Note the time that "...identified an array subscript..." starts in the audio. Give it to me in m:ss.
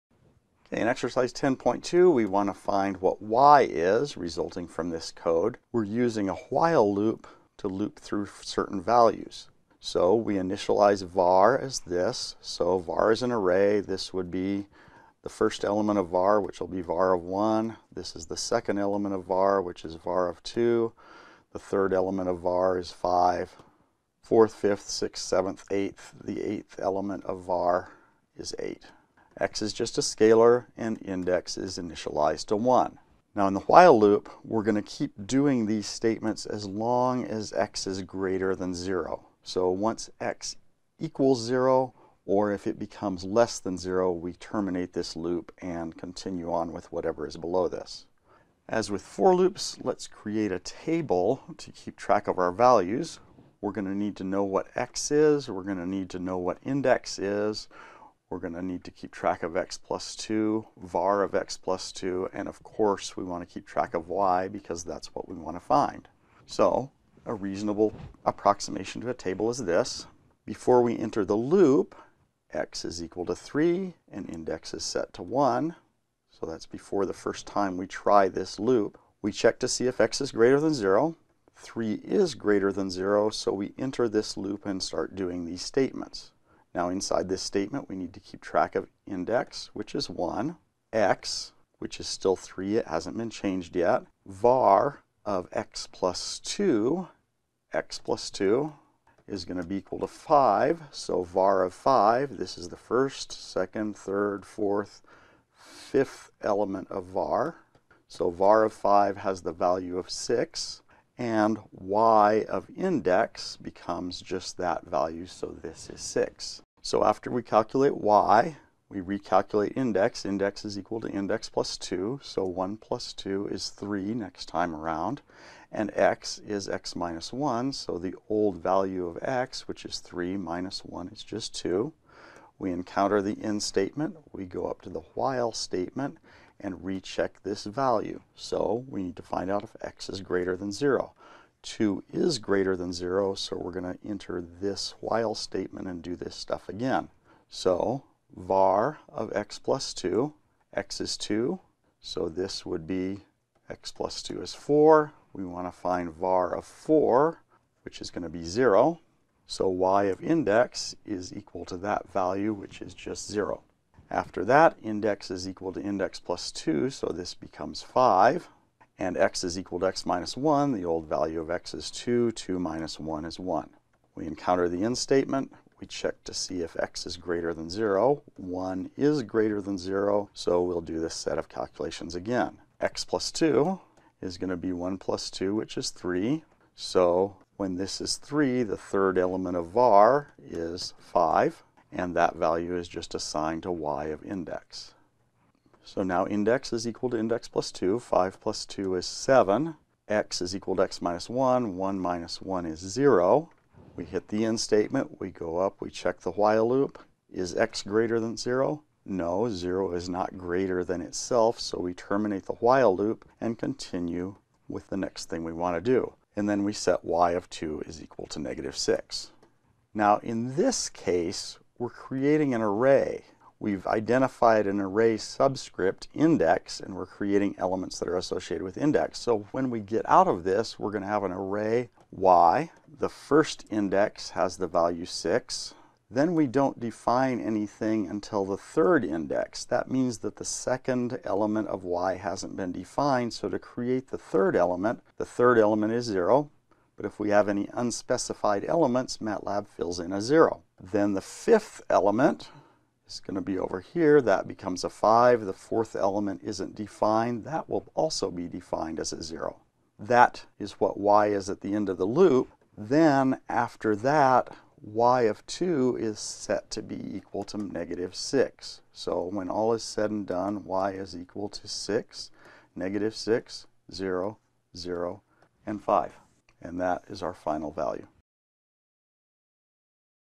3:43.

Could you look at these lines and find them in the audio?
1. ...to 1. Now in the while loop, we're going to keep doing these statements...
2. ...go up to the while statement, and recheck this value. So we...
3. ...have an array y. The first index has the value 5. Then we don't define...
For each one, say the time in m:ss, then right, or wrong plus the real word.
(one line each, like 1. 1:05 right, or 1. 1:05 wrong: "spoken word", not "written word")
1. 0:32 right
2. 2:14 right
3. 3:51 wrong: "6", not "5".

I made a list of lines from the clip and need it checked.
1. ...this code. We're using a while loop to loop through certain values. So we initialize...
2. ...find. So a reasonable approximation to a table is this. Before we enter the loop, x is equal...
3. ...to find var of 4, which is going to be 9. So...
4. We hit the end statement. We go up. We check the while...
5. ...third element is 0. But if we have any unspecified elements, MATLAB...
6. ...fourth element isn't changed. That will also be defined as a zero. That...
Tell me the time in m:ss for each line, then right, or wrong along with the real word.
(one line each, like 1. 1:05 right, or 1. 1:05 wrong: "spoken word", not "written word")
1. 0:04 right
2. 1:05 right
3. 2:35 wrong: "0", not "9"
4. 3:23 right
5. 4:05 right
6. 4:15 wrong: "defined", not "changed".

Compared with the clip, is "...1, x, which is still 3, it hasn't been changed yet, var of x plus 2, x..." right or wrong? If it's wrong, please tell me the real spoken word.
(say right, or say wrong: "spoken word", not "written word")
right.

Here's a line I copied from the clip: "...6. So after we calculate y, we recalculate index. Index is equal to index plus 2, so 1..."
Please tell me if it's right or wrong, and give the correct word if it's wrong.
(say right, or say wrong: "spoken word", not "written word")
right.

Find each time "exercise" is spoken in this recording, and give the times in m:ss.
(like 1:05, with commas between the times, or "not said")
0:00.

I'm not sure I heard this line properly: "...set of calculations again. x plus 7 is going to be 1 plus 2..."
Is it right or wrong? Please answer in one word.
wrong.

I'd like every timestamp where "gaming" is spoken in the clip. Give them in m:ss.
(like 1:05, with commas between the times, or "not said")
not said.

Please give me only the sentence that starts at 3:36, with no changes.
And then we set y of 2 is equal to negative 6.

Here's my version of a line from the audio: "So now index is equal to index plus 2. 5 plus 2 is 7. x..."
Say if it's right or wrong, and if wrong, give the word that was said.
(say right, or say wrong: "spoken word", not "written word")
right.